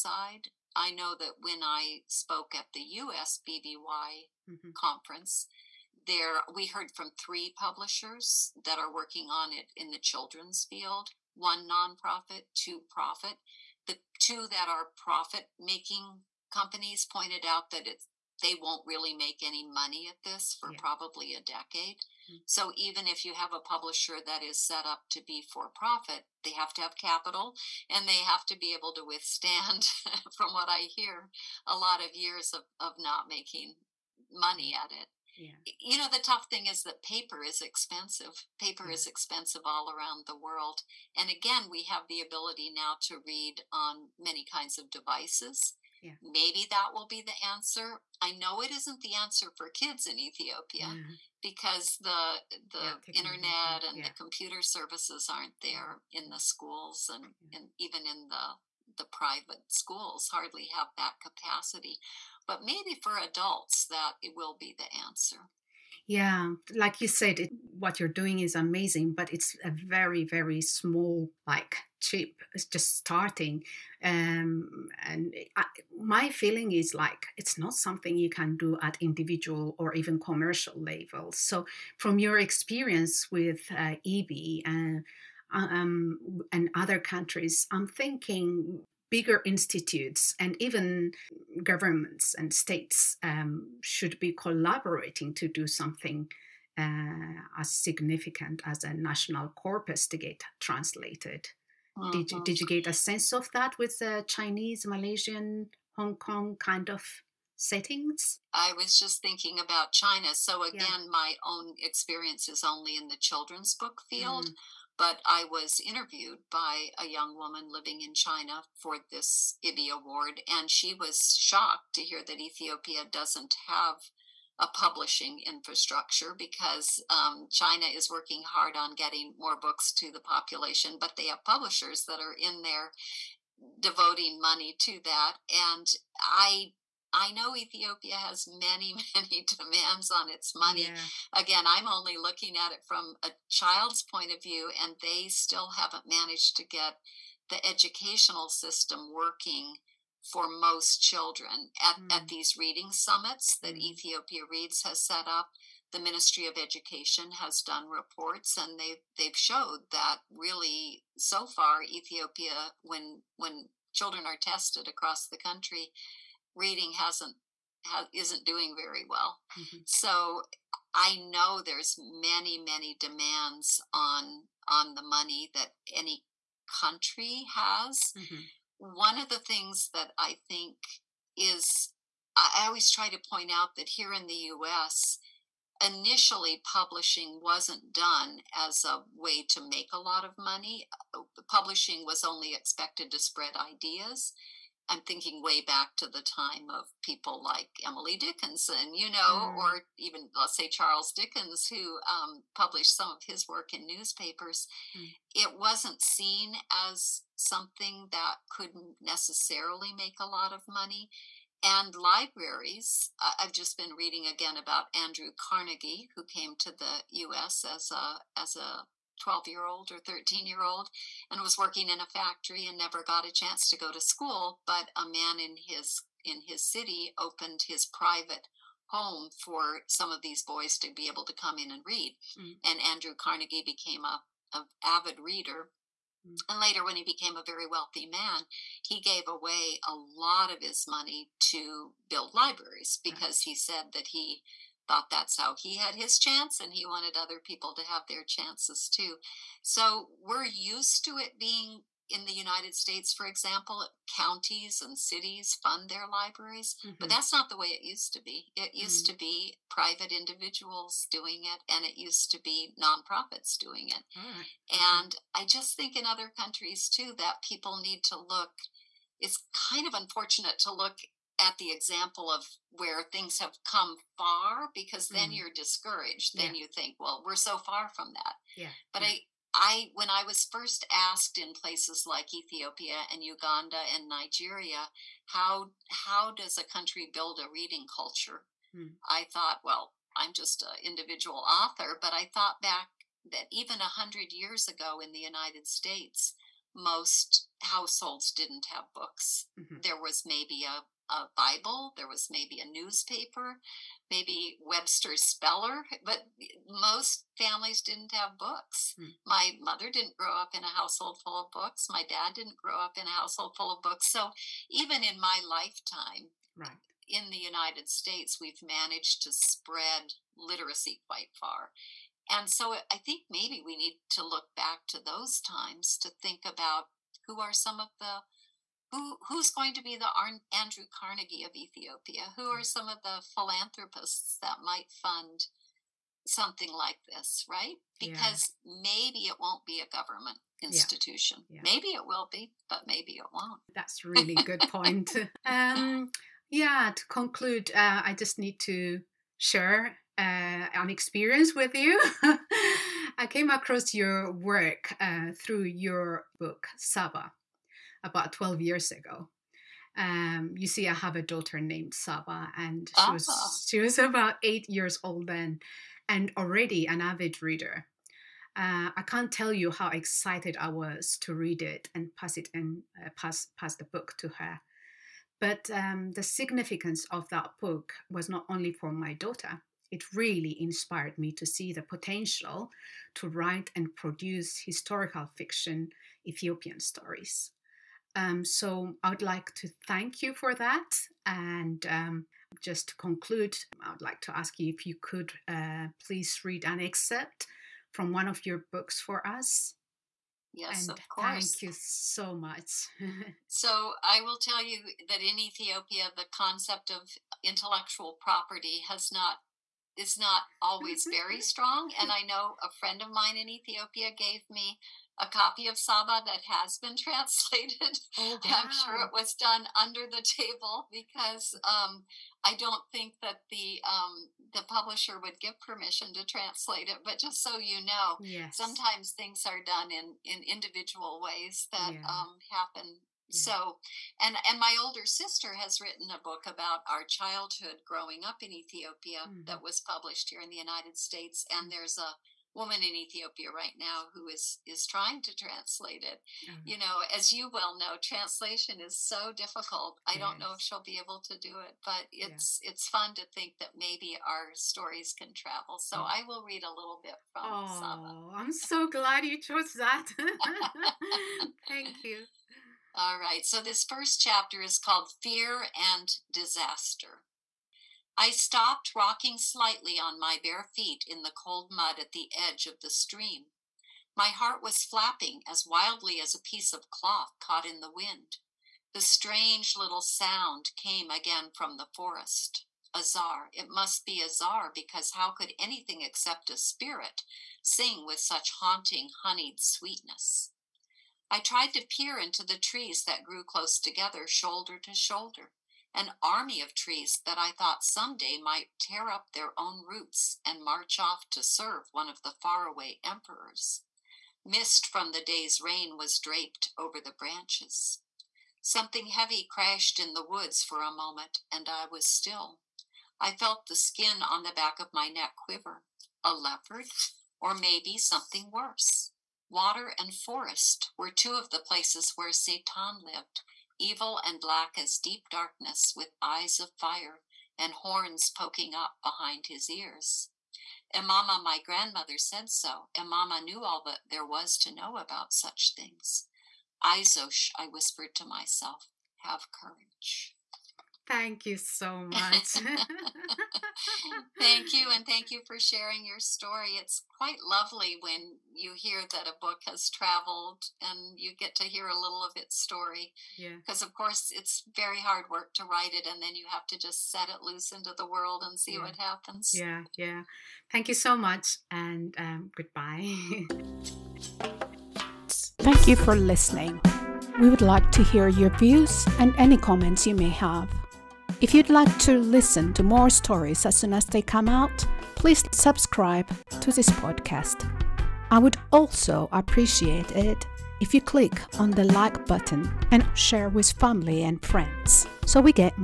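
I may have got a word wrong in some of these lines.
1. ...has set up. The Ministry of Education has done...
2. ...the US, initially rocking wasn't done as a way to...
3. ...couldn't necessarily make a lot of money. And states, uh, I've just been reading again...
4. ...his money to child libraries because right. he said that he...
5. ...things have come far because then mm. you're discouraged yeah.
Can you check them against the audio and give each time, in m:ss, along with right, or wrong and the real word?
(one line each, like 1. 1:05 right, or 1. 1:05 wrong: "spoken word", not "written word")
1. 2:34 right
2. 3:04 wrong: "publishing", not "rocking"
3. 3:28 wrong: "libraries", not "states"
4. 4:00 wrong: "build", not "child"
5. 4:33 right.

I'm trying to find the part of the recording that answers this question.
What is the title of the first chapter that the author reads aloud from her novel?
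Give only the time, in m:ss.
7:45.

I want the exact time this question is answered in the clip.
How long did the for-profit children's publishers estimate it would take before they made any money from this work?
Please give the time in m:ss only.
0:21.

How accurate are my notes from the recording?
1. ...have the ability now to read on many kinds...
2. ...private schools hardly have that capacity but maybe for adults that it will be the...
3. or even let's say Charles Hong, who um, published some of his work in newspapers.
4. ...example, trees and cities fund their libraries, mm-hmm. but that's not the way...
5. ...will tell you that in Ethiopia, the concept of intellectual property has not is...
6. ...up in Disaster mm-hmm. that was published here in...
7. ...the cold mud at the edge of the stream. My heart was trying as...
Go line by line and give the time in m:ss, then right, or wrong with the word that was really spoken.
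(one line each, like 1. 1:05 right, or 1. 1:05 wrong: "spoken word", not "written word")
1. 0:41 right
2. 0:59 right
3. 3:19 wrong: "Dickens", not "Hong"
4. 4:13 wrong: "counties", not "trees"
5. 6:44 right
6. 7:18 wrong: "Ethiopia", not "Disaster"
7. 7:51 wrong: "flapping", not "trying".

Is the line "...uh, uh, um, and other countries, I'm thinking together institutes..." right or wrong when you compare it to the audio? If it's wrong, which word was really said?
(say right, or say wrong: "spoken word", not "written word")
wrong: "bigger", not "together".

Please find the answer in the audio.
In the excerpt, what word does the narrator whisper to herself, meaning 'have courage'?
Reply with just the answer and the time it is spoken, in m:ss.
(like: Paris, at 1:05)
Izosh, at 8:56.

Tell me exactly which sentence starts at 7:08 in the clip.
sometimes things are done in in individual ways that yeah.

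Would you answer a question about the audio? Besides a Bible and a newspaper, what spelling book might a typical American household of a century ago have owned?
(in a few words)
Webster's Speller.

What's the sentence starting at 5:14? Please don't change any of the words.
So even in my lifetime, right.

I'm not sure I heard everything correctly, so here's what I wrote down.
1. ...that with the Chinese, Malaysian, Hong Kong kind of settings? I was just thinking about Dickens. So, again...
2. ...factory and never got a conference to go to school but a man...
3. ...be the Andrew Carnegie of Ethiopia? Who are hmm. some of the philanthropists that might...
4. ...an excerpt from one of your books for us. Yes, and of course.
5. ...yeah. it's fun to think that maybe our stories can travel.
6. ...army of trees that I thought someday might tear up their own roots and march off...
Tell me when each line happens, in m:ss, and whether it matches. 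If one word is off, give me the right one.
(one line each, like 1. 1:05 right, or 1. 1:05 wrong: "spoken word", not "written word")
1. 1:43 wrong: "China", not "Dickens"
2. 3:42 wrong: "chance", not "conference"
3. 5:29 right
4. 6:36 right
5. 7:32 right
6. 8:16 right.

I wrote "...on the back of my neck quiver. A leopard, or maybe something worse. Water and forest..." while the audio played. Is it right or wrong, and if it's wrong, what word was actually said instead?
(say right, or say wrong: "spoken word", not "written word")
right.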